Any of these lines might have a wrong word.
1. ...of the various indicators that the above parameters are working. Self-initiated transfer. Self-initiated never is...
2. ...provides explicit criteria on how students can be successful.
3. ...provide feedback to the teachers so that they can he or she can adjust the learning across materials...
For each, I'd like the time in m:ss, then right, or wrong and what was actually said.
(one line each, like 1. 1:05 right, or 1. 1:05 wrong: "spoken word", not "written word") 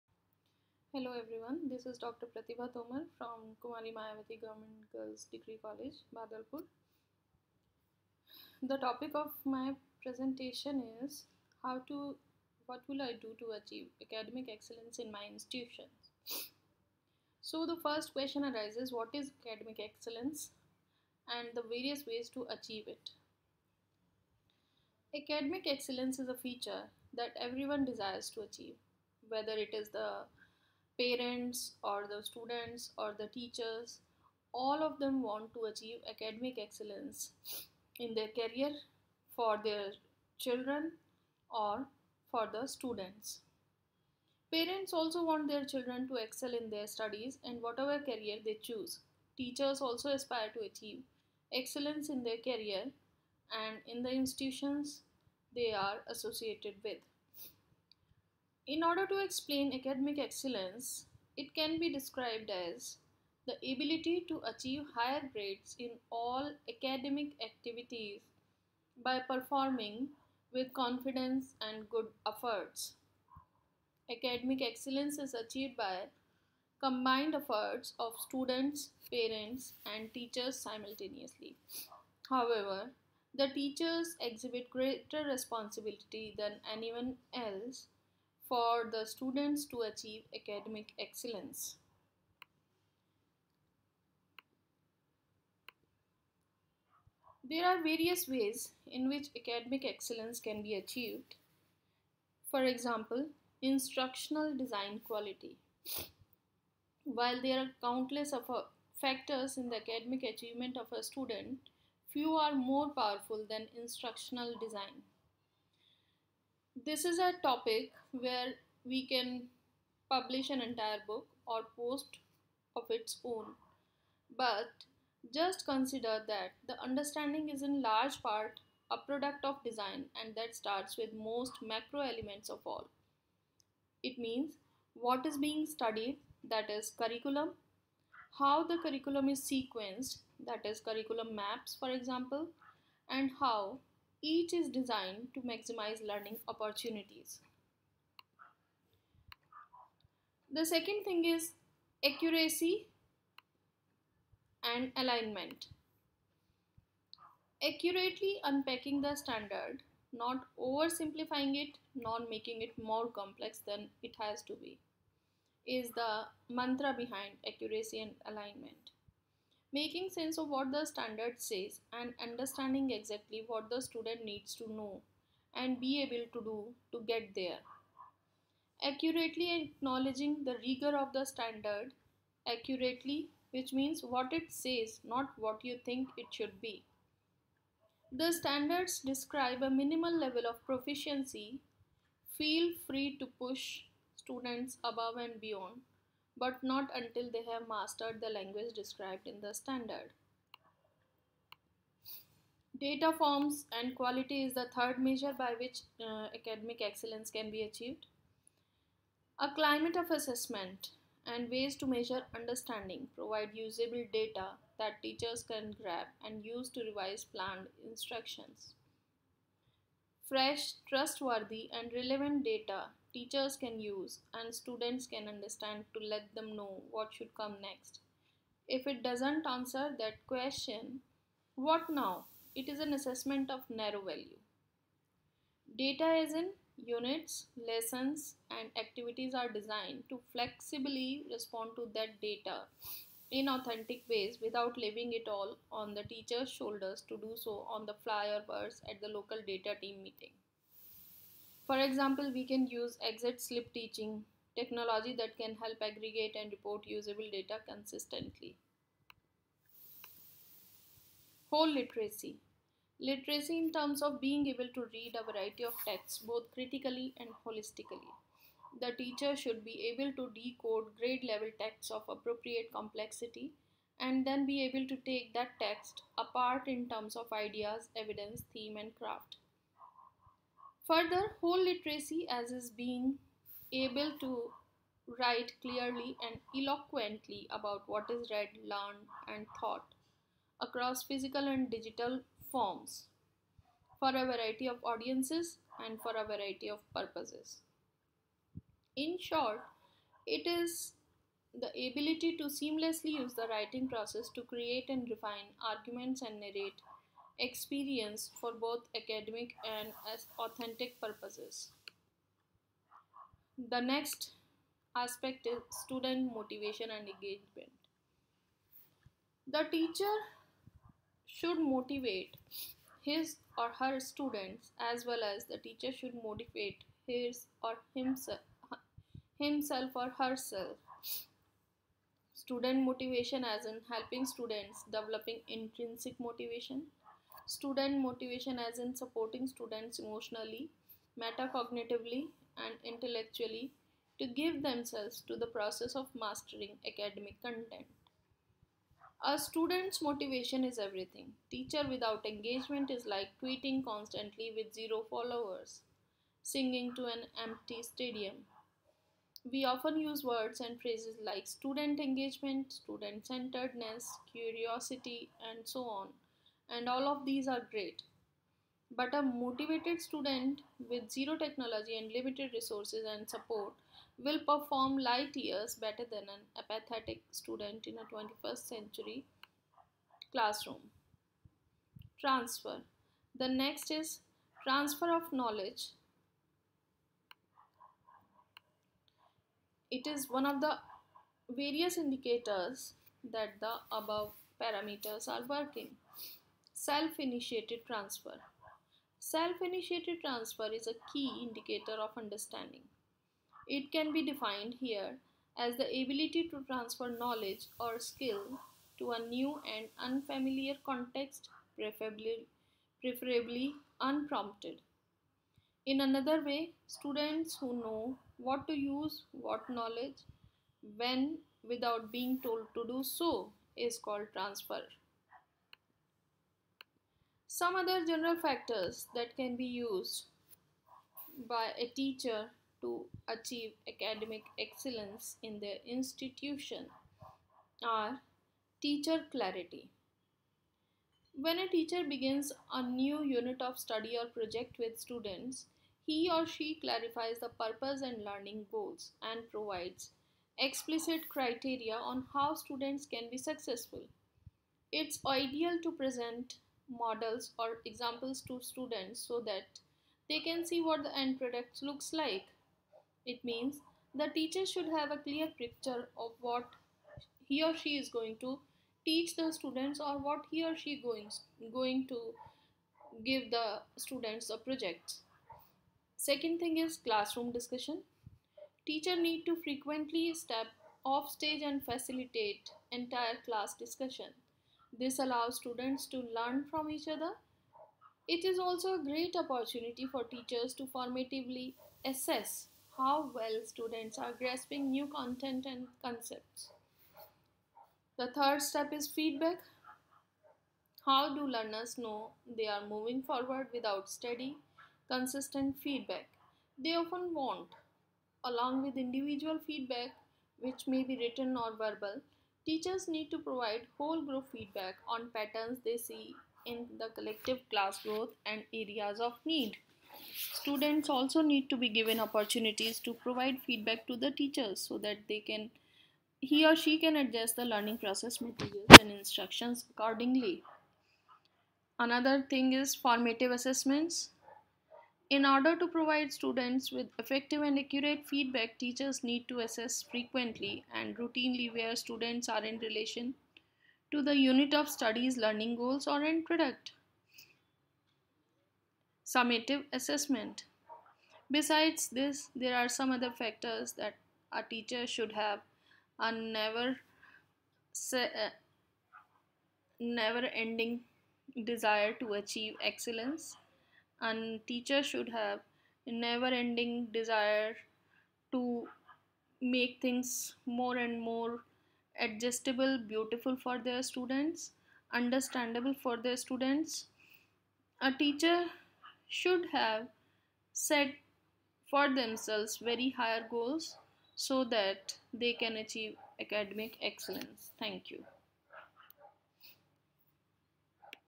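1. 6:30 wrong: "transfer", not "never"
2. 7:29 right
3. 8:43 wrong: "process", not "across".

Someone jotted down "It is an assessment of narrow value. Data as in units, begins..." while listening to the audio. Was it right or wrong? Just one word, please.
wrong.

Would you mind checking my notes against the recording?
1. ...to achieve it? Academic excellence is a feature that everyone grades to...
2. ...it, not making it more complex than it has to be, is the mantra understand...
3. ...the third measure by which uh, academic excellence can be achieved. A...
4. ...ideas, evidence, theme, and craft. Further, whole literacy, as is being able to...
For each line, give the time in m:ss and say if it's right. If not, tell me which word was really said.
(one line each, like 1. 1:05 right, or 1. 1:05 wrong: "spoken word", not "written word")
1. 0:22 wrong: "desires", not "grades"
2. 2:41 wrong: "behind", not "understand"
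3. 3:24 right
4. 4:37 right.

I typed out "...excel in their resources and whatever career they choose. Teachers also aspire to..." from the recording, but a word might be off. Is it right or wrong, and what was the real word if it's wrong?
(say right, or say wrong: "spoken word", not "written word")
wrong: "studies", not "resources".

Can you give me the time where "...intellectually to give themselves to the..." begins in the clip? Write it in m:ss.
5:42.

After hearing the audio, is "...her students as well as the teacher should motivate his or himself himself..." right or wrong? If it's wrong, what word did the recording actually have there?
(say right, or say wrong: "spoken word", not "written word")
right.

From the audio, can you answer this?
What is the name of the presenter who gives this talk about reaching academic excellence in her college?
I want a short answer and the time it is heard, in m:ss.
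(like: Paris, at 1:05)
Dr. Pratibha Tomar, at 0:01.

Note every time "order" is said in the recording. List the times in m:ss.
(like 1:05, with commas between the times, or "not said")
0:58, 8:55.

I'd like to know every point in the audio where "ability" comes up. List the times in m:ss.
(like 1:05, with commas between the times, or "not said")
1:03, 5:01, 6:45.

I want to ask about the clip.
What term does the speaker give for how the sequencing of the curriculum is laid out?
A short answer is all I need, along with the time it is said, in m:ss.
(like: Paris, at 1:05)
Curriculum maps, at 2:20.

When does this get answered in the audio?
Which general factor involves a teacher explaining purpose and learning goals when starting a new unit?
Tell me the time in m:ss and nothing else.
7:18.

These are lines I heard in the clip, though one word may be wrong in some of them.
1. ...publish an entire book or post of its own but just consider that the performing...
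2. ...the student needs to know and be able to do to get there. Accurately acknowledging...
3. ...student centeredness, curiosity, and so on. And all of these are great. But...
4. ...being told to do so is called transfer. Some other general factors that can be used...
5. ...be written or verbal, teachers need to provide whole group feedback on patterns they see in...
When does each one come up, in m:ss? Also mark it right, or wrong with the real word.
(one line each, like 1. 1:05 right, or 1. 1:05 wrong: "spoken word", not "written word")
1. 2:00 wrong: "understanding", not "performing"
2. 2:53 right
3. 6:02 right
4. 7:02 right
5. 8:31 right.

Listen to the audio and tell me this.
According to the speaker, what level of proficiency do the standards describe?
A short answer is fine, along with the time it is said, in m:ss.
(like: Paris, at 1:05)
Minimal, at 3:09.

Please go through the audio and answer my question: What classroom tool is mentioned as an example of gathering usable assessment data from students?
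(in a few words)
Exit slip.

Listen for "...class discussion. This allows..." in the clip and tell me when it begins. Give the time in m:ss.
8:03.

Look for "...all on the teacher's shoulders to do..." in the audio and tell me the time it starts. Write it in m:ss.
4:05.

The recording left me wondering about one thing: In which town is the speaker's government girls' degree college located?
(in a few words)
Badalpur.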